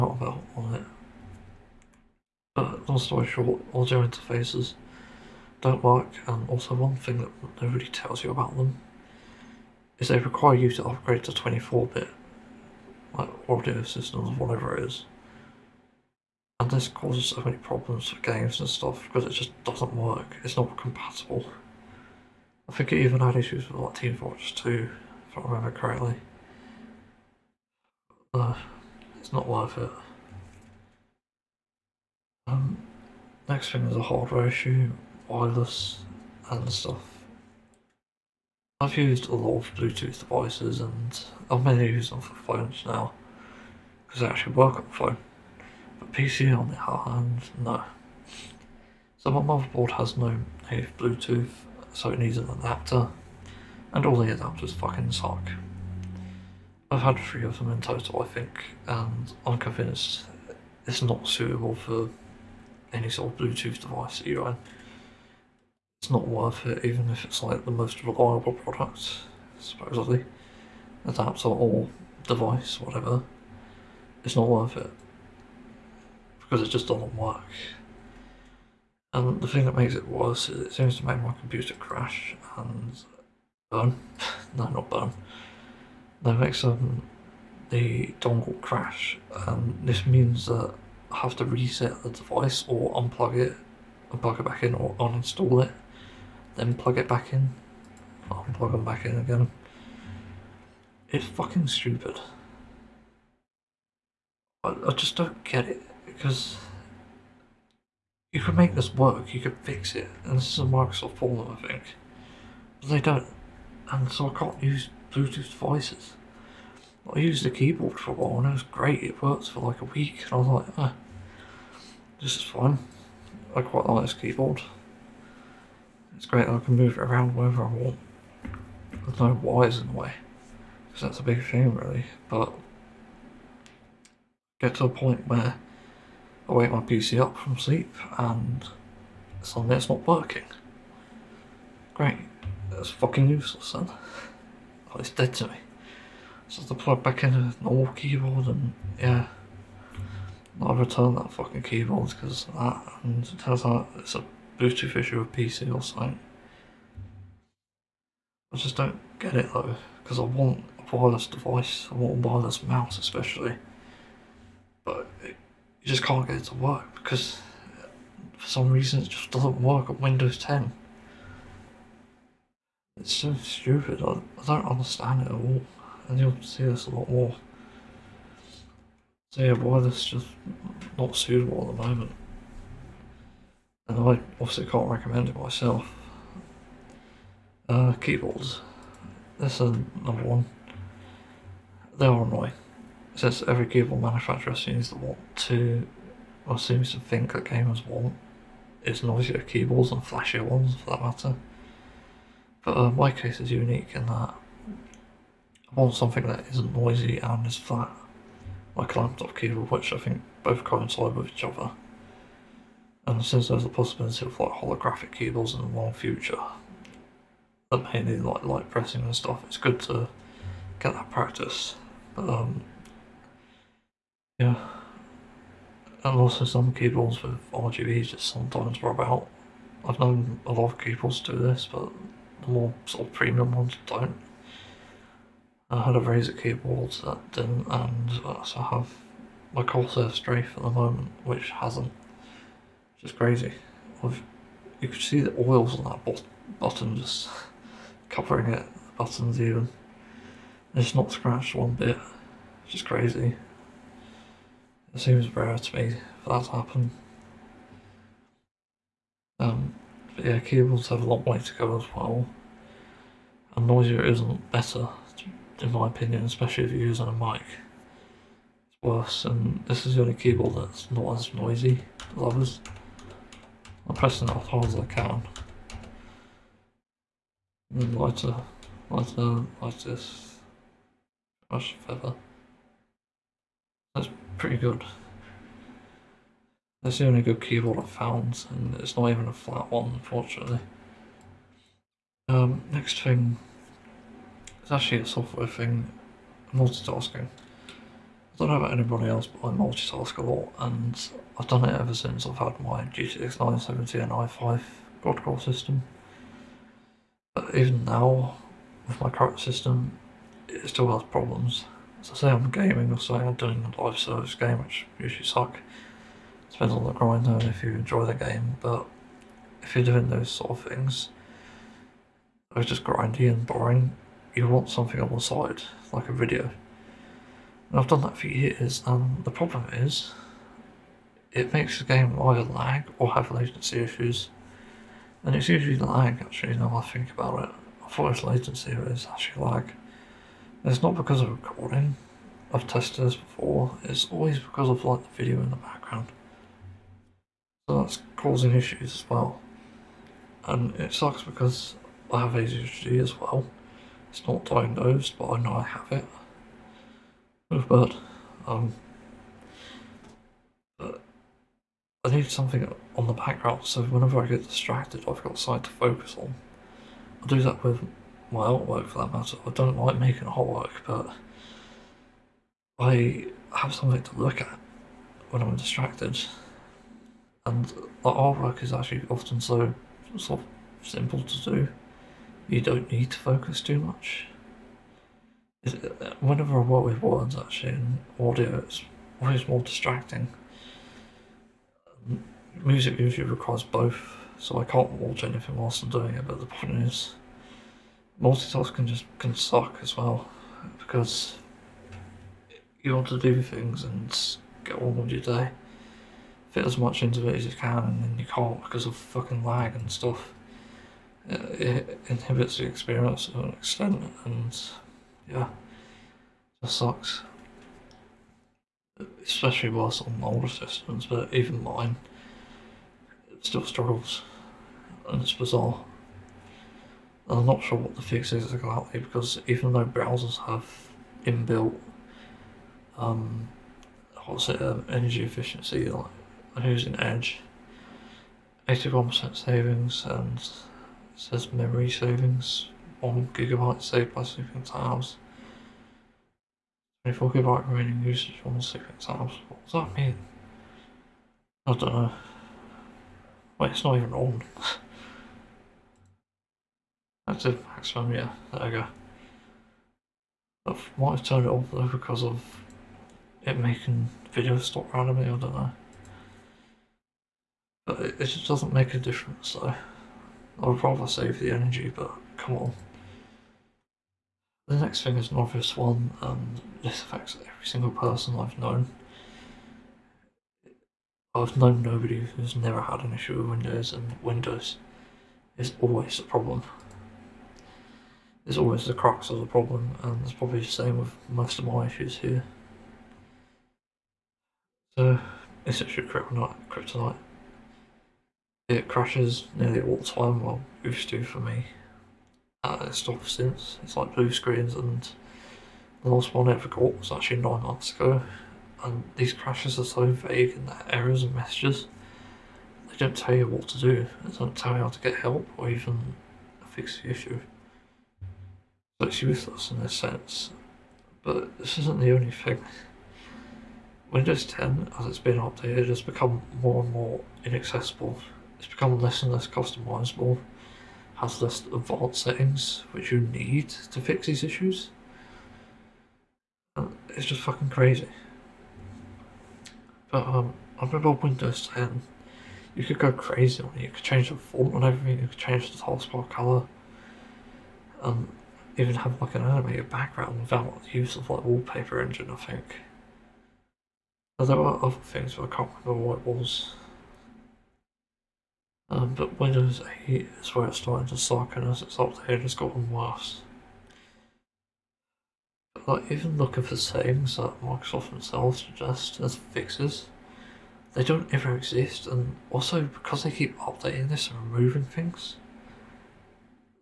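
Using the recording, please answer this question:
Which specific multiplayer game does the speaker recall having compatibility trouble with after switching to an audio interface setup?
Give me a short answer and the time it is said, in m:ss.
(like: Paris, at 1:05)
Team Fortress 2, at 0:23.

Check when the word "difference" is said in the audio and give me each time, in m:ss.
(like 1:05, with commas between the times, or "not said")
7:48.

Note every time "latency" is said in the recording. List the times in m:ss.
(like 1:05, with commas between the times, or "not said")
5:33, 5:38.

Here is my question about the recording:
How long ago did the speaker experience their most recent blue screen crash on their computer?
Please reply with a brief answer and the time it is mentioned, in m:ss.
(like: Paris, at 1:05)
9 months, at 8:27.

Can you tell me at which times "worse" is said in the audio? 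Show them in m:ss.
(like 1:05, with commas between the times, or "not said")
1:20, 4:28, 9:22.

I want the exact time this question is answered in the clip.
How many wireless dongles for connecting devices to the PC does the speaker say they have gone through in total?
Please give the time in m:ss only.
0:57.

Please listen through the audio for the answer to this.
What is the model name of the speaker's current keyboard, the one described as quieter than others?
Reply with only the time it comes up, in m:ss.
3:59.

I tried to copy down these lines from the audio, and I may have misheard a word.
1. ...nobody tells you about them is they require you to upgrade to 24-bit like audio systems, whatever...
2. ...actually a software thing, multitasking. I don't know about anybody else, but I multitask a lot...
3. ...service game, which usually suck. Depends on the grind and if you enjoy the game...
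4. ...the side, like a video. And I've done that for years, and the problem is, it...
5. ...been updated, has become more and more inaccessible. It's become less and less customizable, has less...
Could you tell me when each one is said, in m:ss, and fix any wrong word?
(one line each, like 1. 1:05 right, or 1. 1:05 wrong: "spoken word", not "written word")
1. 0:07 right
2. 4:54 right
3. 5:13 right
4. 5:25 right
5. 8:45 right.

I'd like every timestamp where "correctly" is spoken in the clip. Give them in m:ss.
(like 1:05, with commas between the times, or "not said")
0:25.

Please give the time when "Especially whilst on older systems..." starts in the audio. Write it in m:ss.
6:59.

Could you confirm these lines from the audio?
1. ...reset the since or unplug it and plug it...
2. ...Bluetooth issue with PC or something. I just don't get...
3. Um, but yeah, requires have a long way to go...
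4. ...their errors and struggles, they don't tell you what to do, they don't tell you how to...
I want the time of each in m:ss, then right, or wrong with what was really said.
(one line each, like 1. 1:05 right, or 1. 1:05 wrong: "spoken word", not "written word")
1. 1:31 wrong: "device", not "since"
2. 2:34 right
3. 4:19 wrong: "cables", not "requires"
4. 8:30 wrong: "messages", not "struggles".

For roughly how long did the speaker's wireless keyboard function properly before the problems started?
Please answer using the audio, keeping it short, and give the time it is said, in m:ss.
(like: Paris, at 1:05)
a week, at 1:59.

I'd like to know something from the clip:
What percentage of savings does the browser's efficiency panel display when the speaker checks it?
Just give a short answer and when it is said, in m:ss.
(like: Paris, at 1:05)
81%, at 7:18.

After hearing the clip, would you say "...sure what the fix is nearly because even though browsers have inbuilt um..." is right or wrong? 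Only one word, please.
wrong.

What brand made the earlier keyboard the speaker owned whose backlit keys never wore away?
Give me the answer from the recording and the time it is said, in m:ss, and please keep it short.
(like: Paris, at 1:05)
Razer, at 3:56.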